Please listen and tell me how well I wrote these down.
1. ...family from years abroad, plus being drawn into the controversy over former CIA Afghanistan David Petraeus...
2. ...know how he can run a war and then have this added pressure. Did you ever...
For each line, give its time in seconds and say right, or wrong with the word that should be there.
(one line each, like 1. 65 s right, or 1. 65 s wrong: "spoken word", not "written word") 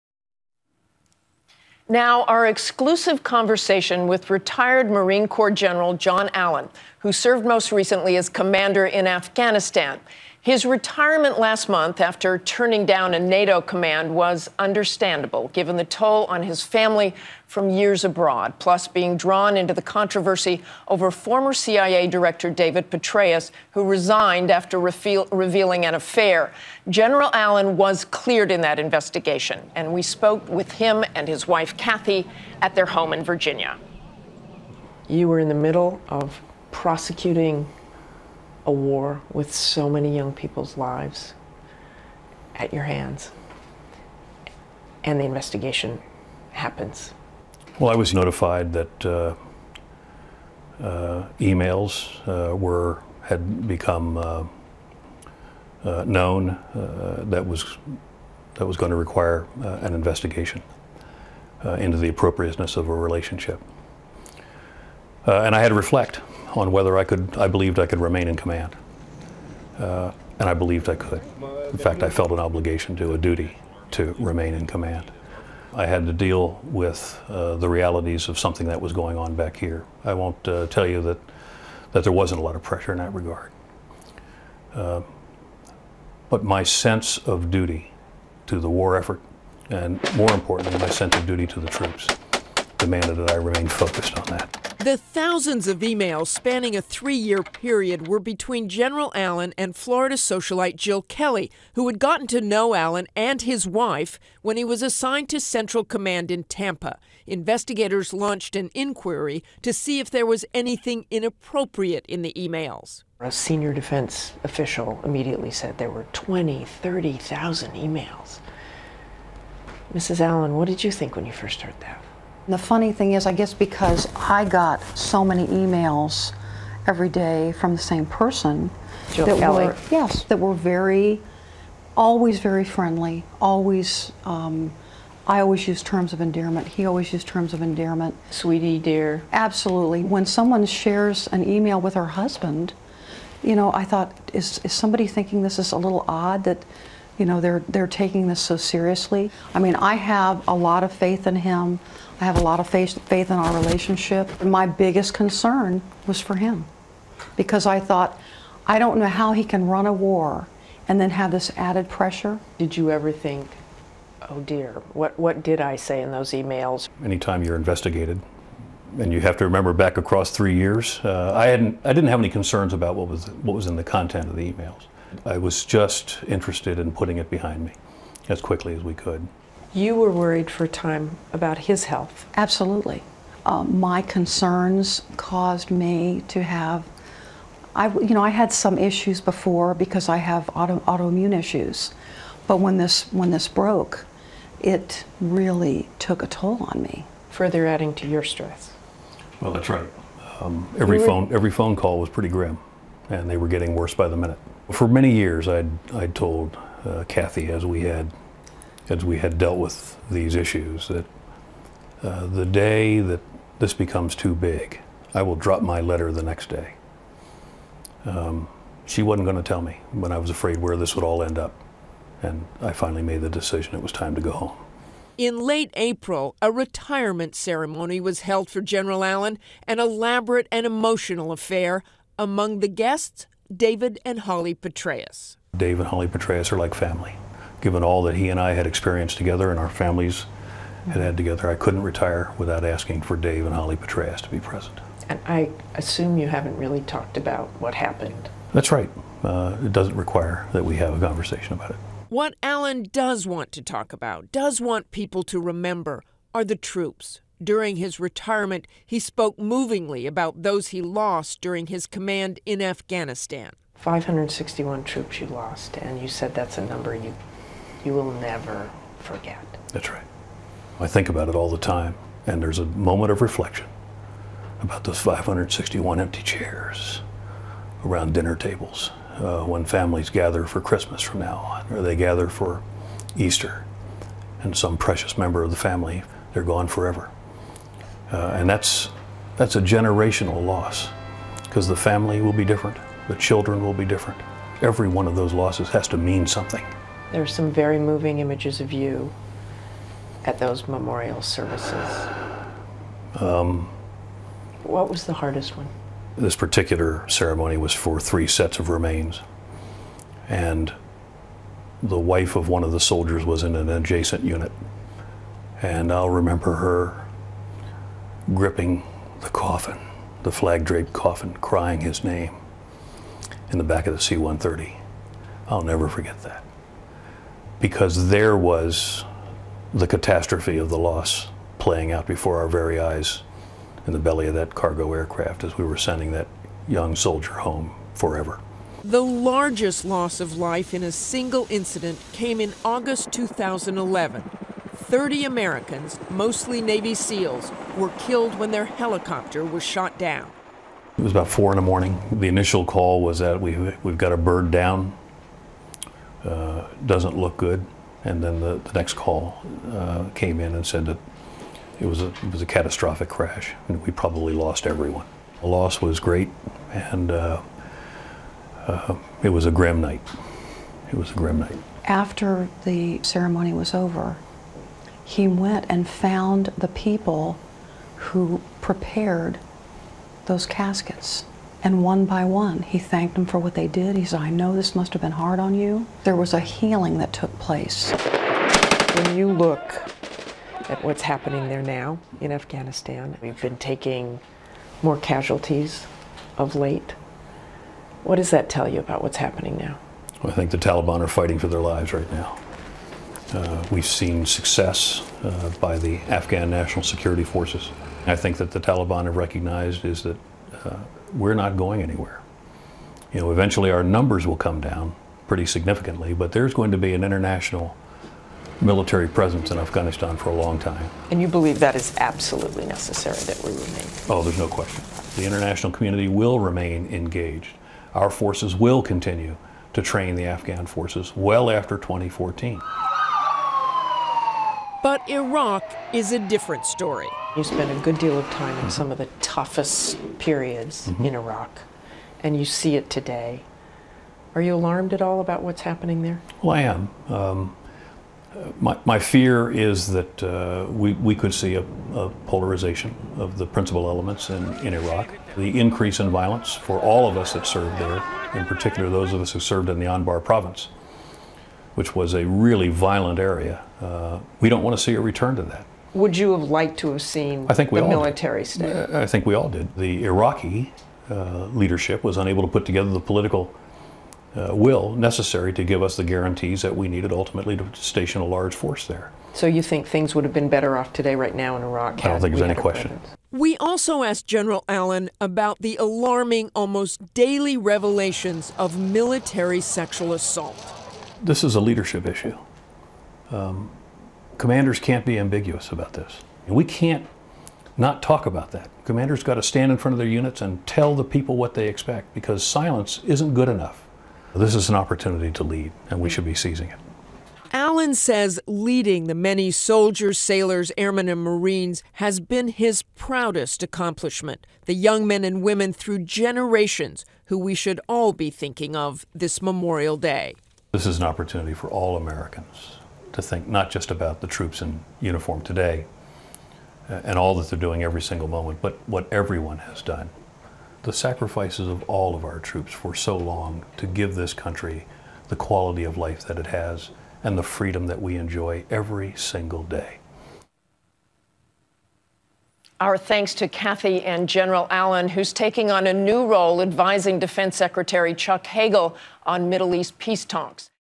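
1. 16 s wrong: "Director", not "Afghanistan"
2. 158 s right.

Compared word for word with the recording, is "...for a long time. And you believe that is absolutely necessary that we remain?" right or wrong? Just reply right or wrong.
right.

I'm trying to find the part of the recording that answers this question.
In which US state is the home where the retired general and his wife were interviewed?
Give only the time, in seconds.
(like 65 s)
33 s.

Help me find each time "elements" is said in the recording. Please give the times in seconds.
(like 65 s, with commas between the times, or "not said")
453 s.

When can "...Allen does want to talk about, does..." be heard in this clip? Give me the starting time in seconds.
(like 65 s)
252 s.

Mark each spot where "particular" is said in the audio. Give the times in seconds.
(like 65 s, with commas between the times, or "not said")
306 s, 458 s.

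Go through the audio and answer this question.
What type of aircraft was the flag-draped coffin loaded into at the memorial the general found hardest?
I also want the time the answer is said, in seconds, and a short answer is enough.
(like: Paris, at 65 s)
C-130, at 324 s.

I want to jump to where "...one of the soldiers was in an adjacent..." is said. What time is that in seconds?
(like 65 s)
312 s.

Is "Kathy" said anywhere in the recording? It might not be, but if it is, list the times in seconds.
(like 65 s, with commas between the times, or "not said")
31 s, 207 s, 543 s.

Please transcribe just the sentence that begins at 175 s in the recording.
I was just interested in putting it behind me as quickly as we could.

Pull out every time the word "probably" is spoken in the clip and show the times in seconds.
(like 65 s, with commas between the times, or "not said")
363 s.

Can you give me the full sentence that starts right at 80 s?
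I won't uh, tell you that, that there wasn't a lot of pressure in that regard.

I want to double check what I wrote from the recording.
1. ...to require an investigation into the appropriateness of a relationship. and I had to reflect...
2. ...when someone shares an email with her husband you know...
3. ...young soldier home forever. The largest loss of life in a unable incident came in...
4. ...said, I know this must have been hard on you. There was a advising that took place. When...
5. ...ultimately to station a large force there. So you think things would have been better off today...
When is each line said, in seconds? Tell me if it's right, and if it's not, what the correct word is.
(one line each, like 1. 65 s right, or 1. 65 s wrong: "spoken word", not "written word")
1. 58 s right
2. 140 s right
3. 336 s wrong: "single", not "unable"
4. 384 s wrong: "healing", not "advising"
5. 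477 s right.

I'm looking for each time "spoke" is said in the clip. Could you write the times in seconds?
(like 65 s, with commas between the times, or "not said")
30 s, 258 s.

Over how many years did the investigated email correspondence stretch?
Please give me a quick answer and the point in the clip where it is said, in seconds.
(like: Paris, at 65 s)
3, at 96 s.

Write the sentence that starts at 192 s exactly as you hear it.
But when this, when this broke, it really took a toll on me.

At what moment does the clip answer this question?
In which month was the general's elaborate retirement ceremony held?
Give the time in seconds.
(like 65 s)
225 s.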